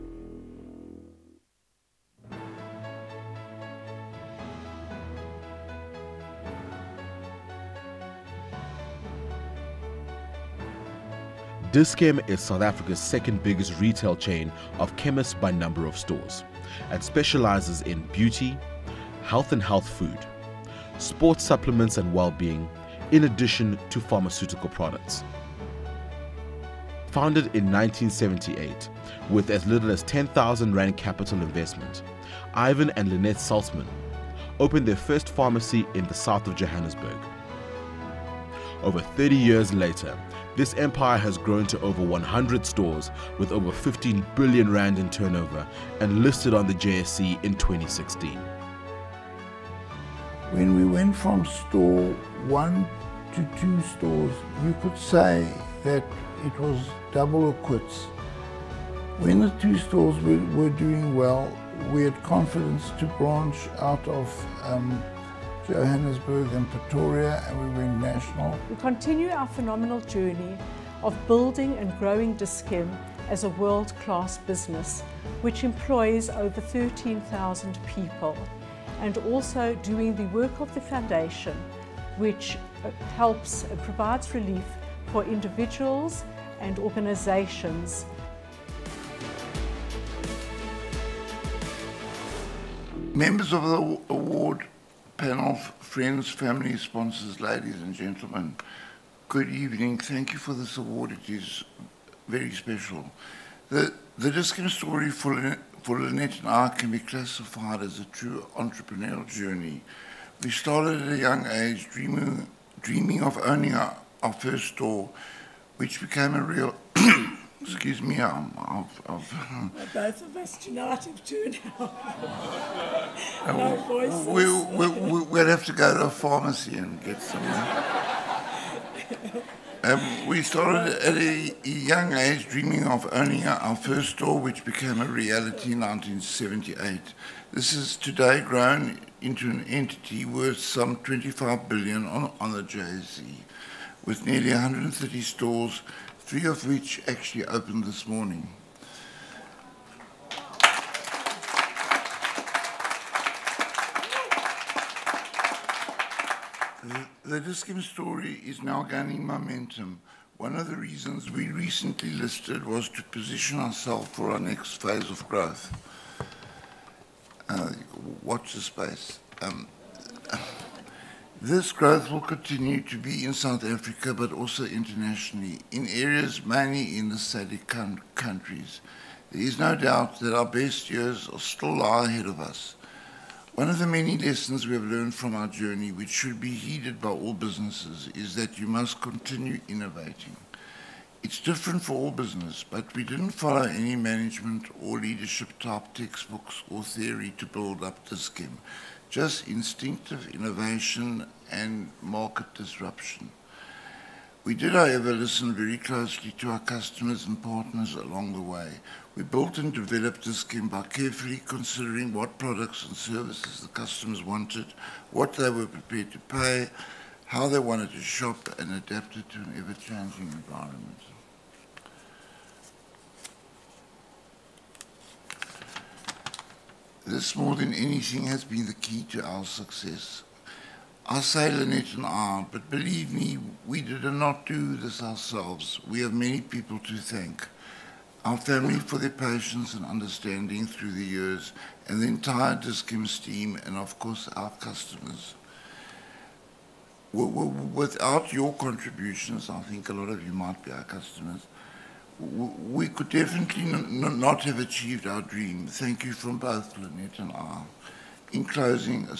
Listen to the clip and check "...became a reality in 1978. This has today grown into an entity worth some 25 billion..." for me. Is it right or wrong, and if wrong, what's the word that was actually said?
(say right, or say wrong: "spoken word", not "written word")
right.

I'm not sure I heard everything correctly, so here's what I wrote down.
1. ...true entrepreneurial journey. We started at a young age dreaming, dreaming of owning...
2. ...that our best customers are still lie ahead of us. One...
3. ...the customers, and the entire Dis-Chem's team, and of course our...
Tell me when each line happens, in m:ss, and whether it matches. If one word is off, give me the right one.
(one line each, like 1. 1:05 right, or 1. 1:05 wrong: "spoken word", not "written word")
1. 1:48 right
2. 3:00 wrong: "years", not "customers"
3. 4:00 wrong: "years", not "customers".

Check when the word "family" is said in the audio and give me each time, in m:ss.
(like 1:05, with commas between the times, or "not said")
1:36, 3:58.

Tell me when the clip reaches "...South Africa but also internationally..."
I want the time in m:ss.
2:53.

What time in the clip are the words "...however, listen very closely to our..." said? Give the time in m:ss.
3:24.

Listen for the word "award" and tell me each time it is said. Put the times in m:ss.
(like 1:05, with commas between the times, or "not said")
1:34, 1:40.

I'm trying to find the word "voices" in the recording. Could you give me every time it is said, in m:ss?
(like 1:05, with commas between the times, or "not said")
2:03.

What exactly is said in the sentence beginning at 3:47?
this more than anything has been the key to our success.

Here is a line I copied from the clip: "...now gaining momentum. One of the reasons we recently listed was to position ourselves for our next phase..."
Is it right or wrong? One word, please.
right.